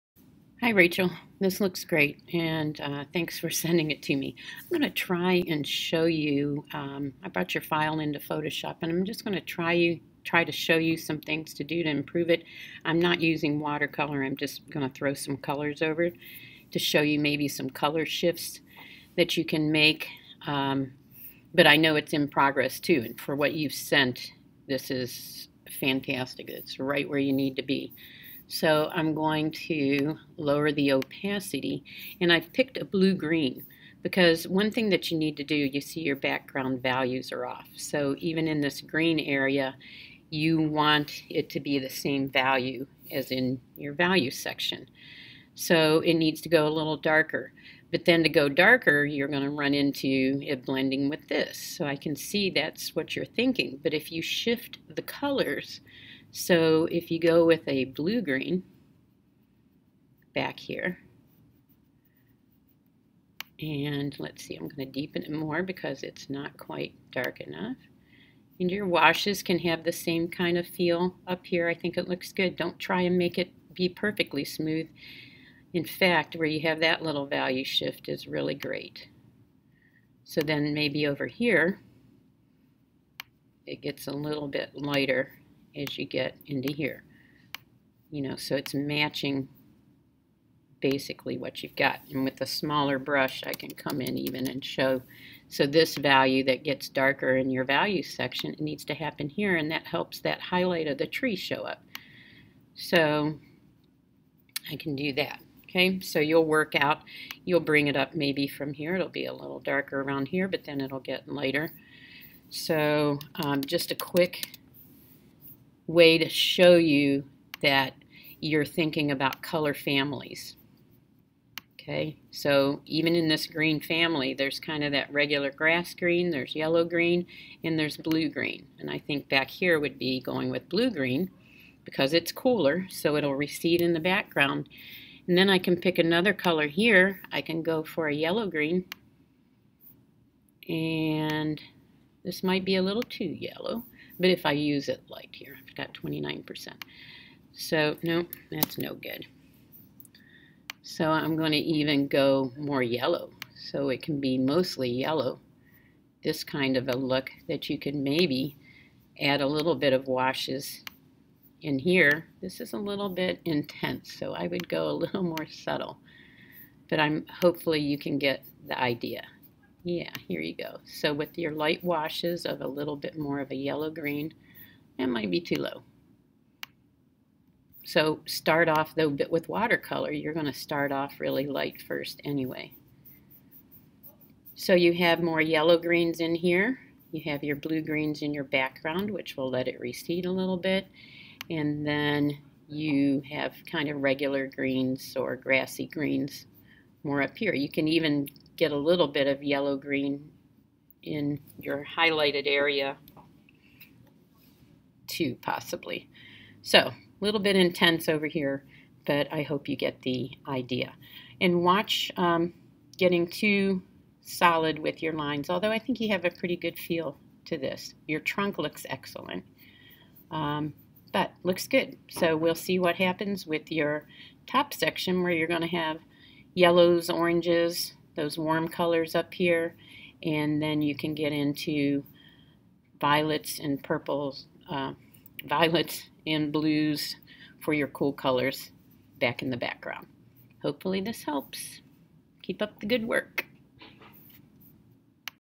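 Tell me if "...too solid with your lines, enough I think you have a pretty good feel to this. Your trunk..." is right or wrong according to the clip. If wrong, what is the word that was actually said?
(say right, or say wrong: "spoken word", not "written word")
wrong: "although", not "enough".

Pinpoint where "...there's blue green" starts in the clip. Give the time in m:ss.
2:07.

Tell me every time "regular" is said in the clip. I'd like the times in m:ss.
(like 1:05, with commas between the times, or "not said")
2:05, 3:13.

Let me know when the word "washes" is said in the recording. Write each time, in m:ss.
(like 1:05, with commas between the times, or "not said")
1:08, 2:40, 2:51.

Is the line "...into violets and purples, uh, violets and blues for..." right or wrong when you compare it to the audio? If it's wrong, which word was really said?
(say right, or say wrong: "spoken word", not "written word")
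right.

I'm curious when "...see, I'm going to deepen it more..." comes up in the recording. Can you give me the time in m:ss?
1:04.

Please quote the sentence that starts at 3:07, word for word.
You have your blue-greens in your background, which will let it recede a little bit.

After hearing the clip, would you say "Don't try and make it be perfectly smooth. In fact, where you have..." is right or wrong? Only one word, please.
right.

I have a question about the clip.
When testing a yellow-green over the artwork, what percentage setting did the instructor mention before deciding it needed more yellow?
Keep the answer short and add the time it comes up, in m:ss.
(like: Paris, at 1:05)
29%, at 2:25.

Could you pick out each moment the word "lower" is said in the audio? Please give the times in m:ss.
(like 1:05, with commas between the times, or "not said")
0:30.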